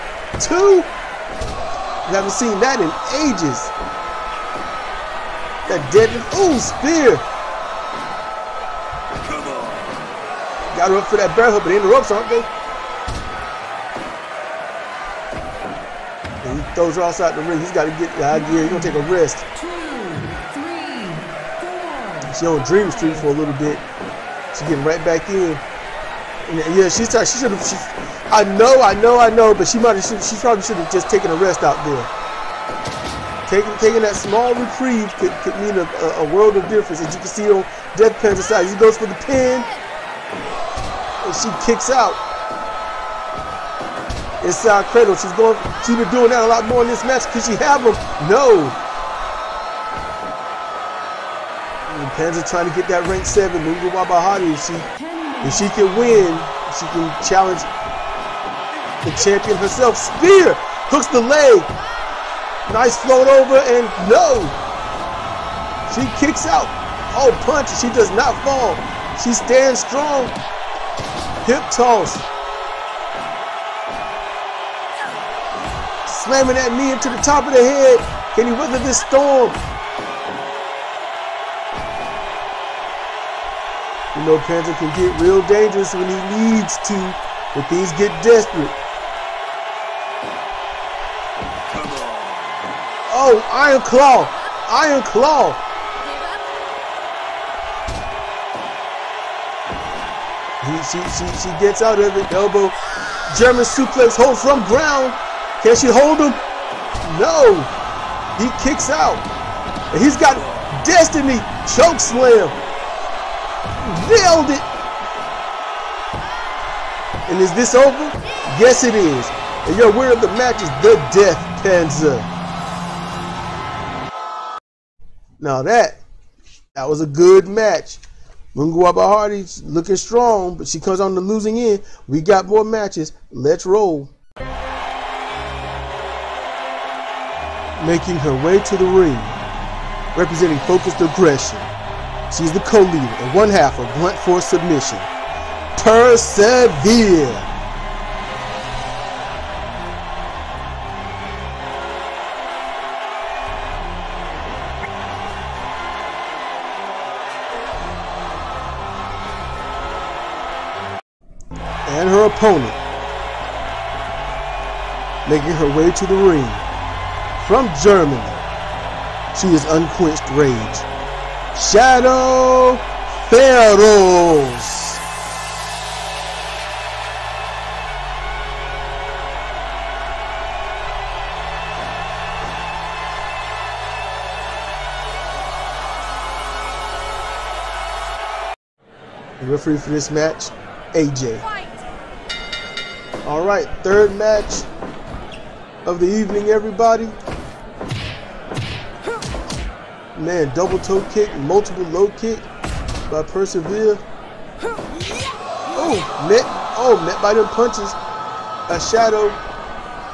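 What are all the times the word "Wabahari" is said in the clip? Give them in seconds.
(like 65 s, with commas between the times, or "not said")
53 s, 128 s.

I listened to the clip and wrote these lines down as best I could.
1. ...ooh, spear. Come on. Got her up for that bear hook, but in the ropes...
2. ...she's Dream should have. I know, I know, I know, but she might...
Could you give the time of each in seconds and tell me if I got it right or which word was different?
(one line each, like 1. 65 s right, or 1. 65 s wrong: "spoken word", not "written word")
1. 6 s right
2. 26 s wrong: "She", not "Dream".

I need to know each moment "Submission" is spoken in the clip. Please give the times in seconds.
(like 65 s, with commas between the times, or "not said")
144 s.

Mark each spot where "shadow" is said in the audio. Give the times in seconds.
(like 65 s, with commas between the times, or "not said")
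171 s, 208 s.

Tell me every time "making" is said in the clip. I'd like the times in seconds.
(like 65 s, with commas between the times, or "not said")
137 s, 165 s.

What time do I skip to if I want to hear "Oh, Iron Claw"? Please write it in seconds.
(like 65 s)
93 s.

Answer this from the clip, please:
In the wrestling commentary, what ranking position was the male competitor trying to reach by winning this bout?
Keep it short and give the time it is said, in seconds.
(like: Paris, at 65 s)
Rank 7, at 53 s.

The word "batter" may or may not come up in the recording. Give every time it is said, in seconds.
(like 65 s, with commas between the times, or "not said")
not said.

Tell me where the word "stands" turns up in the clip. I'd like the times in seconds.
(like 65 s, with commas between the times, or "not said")
69 s.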